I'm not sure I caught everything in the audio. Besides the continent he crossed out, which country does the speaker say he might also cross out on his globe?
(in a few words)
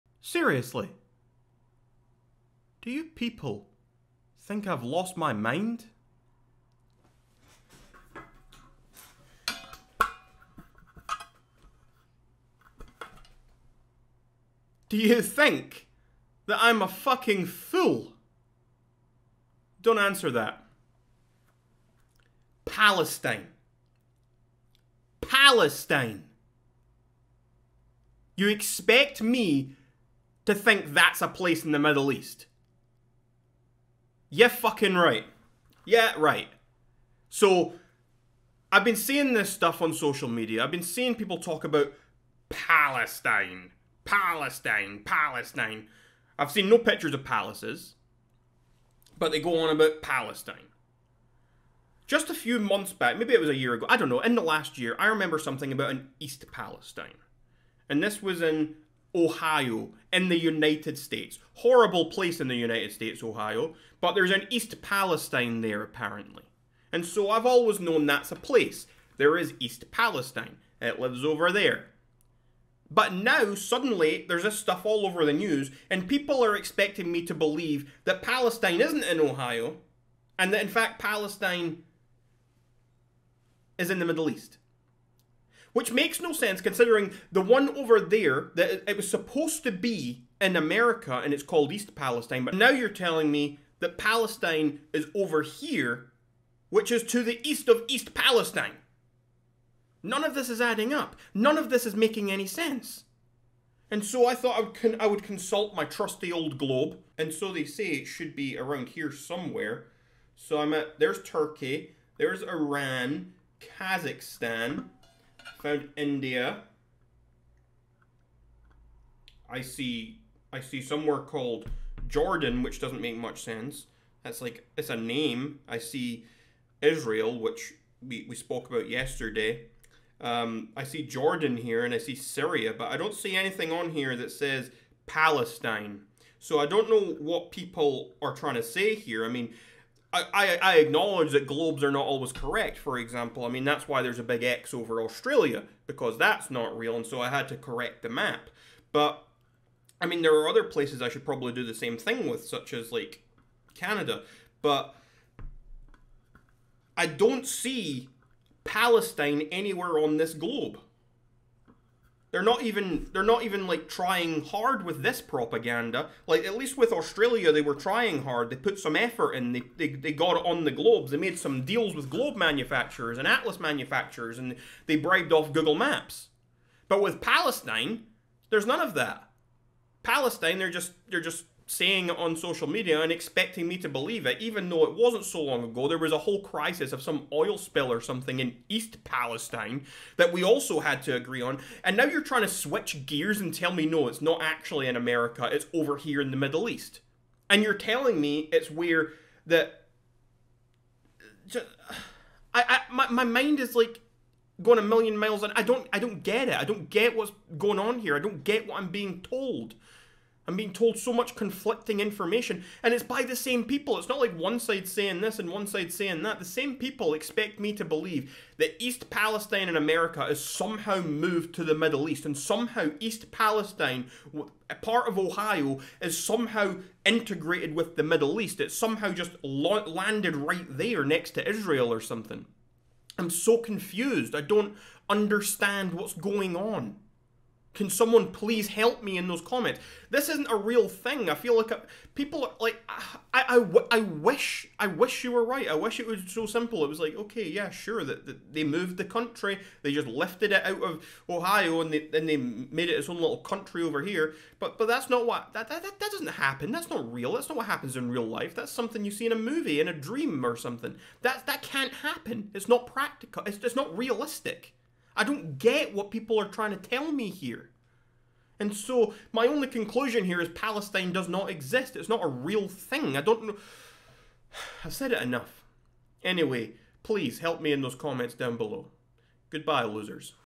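Canada.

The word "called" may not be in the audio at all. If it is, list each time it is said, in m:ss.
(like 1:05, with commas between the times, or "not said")
1:31, 2:01.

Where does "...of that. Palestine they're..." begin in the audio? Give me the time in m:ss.
2:58.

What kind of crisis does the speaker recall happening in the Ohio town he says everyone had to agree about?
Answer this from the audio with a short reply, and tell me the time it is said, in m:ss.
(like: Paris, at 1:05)
oil spill, at 3:07.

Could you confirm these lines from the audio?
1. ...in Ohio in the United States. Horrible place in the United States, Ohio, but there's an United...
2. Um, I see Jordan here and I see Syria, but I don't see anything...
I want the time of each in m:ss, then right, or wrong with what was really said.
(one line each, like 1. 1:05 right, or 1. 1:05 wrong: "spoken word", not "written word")
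1. 0:58 wrong: "East", not "United"
2. 2:10 right.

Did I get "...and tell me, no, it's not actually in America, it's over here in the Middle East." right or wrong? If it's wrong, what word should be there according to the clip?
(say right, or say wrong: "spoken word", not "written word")
right.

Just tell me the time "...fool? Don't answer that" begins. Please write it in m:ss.
0:17.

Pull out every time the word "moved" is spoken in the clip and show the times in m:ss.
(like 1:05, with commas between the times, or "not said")
3:41, 4:08.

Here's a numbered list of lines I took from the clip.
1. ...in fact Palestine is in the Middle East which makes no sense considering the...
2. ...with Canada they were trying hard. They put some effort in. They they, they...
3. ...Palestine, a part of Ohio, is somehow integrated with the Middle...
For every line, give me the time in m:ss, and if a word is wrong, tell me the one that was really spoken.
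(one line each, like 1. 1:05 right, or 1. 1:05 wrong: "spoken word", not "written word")
1. 1:20 right
2. 2:46 wrong: "Australia", not "Canada"
3. 3:43 right.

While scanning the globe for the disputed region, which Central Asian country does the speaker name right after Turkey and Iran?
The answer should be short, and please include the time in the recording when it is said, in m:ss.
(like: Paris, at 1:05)
Kazakhstan, at 1:53.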